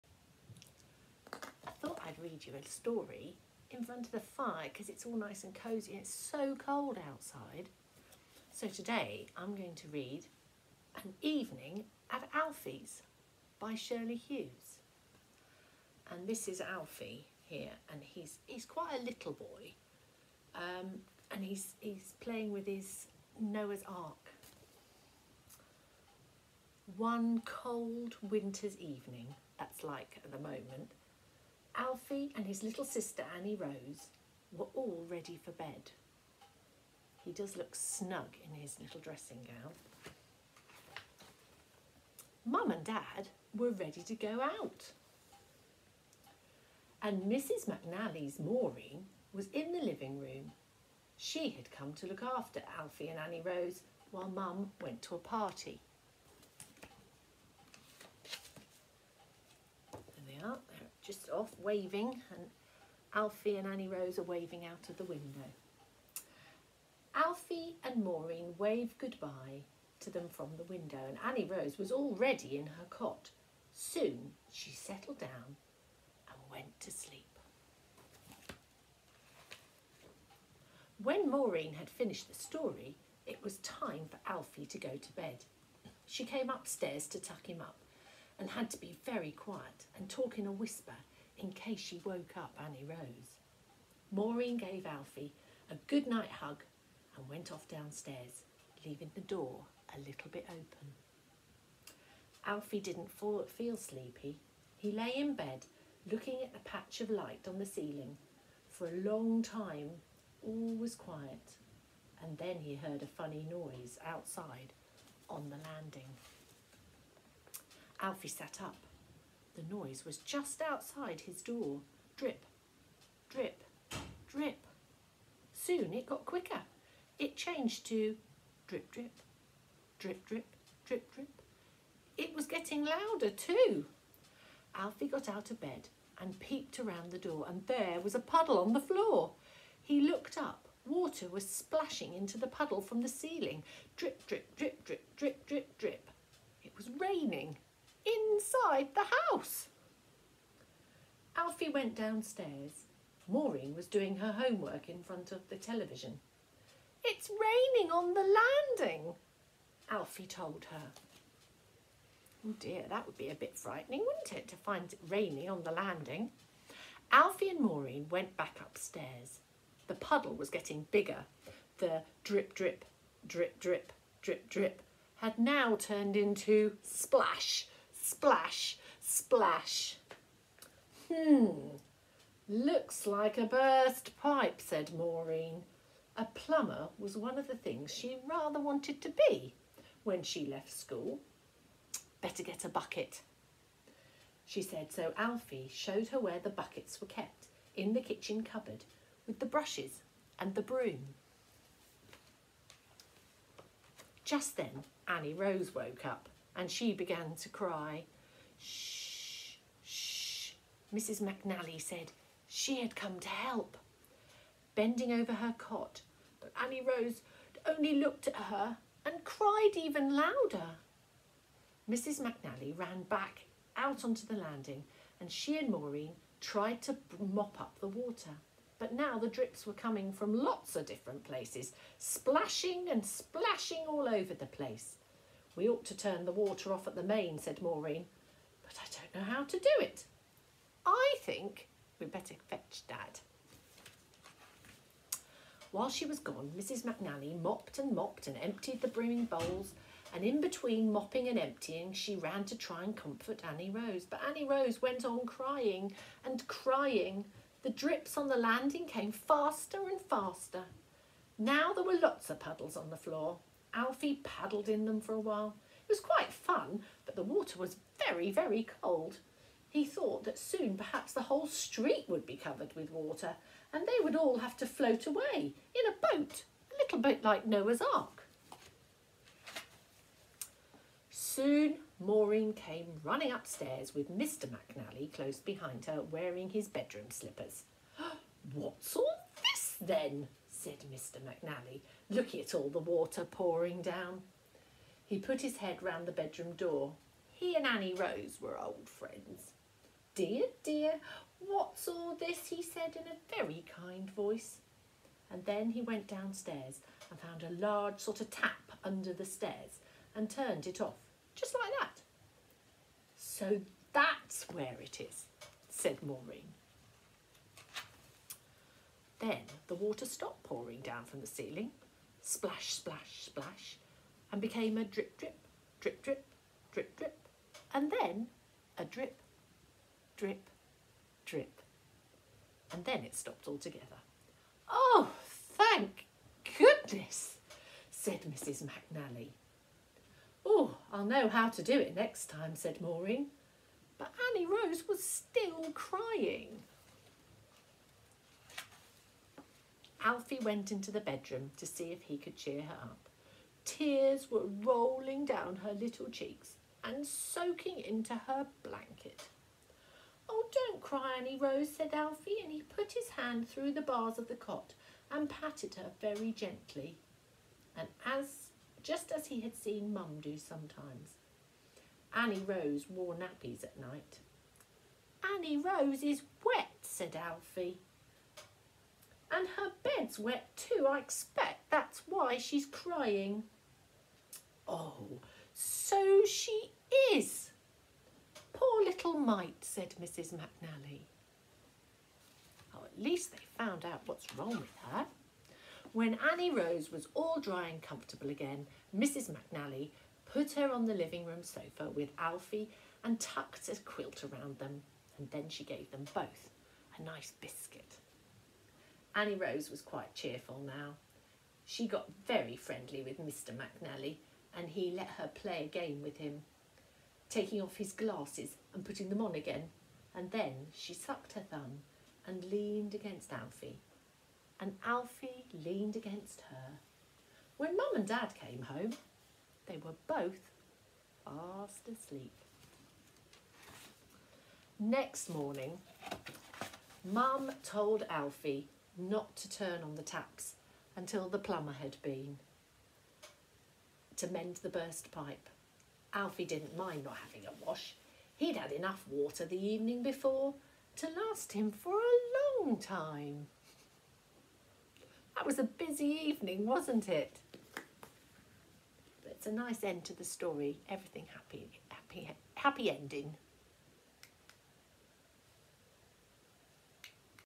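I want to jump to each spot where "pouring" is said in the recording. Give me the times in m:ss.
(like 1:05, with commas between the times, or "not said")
4:53, 5:20.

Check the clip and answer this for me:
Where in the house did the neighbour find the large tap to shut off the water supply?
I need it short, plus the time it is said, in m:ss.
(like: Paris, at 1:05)
Under the stairs, at 5:08.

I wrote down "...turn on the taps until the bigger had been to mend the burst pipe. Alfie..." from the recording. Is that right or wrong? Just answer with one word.
wrong.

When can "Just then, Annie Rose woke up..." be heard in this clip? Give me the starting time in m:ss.
3:24.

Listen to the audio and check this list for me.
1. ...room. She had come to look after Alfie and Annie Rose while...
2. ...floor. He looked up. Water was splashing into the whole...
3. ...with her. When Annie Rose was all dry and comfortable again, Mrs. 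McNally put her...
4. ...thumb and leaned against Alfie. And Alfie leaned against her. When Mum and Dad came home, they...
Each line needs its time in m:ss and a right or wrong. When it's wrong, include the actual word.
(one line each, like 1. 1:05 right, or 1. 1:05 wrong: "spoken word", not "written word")
1. 0:50 right
2. 2:18 wrong: "puddle", not "whole"
3. 6:34 right
4. 7:01 right.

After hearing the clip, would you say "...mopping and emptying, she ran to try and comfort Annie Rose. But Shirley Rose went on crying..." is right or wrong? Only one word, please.
wrong.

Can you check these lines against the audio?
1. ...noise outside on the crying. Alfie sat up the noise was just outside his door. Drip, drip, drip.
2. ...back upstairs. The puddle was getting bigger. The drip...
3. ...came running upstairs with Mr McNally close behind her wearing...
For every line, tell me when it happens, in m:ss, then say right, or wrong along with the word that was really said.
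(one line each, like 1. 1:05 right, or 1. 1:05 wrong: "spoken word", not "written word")
1. 1:53 wrong: "landing", not "crying"
2. 2:48 right
3. 4:42 right.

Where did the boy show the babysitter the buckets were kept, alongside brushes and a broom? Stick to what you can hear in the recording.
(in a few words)
The kitchen cupboard.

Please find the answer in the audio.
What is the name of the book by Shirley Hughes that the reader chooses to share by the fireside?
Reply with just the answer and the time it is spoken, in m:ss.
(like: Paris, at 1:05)
An Evening at Alfie's, at 0:11.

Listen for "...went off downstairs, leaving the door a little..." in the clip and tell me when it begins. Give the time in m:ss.
1:37.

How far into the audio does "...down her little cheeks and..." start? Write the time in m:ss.
5:55.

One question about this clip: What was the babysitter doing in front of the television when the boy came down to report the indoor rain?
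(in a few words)
Her homework.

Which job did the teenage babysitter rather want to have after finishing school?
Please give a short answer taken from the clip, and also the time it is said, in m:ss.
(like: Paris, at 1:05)
A plumber, at 3:06.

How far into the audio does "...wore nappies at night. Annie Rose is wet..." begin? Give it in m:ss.
6:12.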